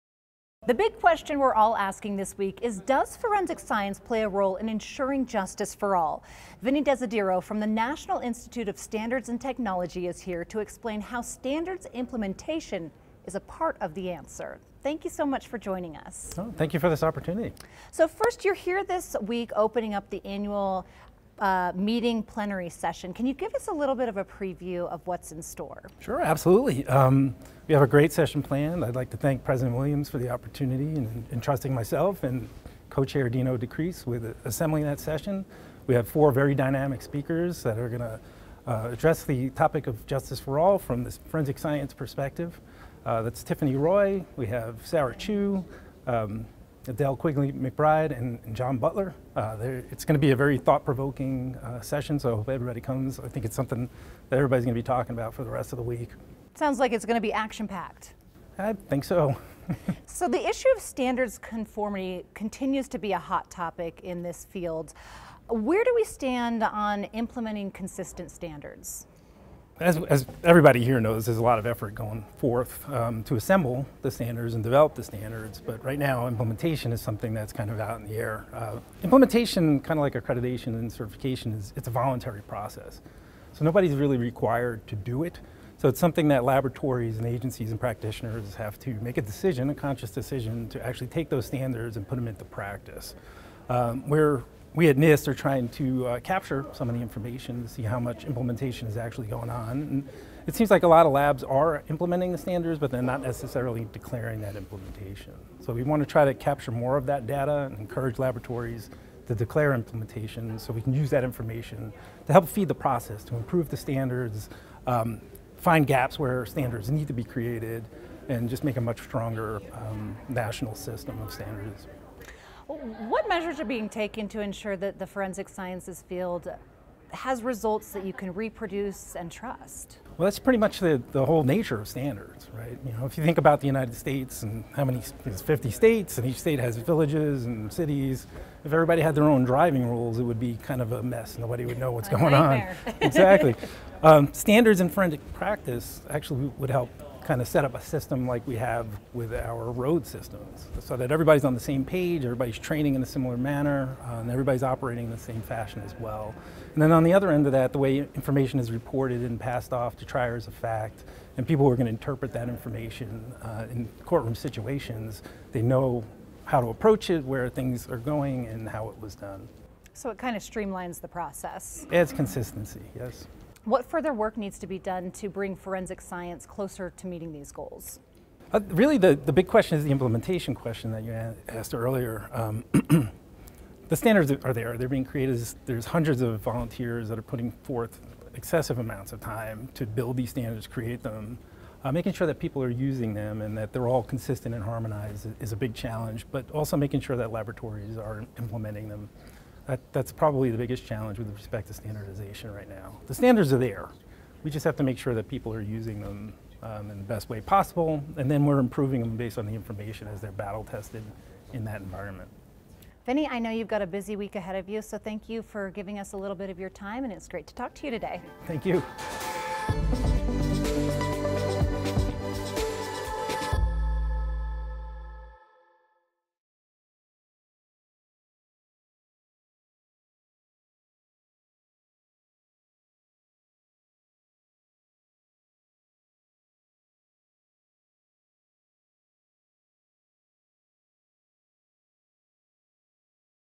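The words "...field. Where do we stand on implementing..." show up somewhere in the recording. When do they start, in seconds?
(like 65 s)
64 s.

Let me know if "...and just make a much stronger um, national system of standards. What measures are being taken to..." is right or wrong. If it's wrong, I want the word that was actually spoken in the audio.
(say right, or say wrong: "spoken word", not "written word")
right.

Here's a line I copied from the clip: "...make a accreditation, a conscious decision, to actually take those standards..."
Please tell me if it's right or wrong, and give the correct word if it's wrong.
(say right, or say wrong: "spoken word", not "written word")
wrong: "decision", not "accreditation".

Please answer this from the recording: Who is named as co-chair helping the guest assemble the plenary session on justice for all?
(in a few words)
Dino DeCrease.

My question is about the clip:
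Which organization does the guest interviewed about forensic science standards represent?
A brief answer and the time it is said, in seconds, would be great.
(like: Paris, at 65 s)
National Institute of Standards and Technology, at 7 s.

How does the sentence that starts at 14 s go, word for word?
Thank you so much for joining us.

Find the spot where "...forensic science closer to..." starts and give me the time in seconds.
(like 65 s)
175 s.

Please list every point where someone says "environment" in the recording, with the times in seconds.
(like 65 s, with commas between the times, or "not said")
211 s.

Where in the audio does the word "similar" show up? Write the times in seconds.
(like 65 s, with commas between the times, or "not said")
153 s.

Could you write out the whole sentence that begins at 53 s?
I think it's something that everybody's going to be talking about for the rest of the week.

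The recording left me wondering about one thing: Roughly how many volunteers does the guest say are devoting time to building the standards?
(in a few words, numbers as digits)
Hundreds.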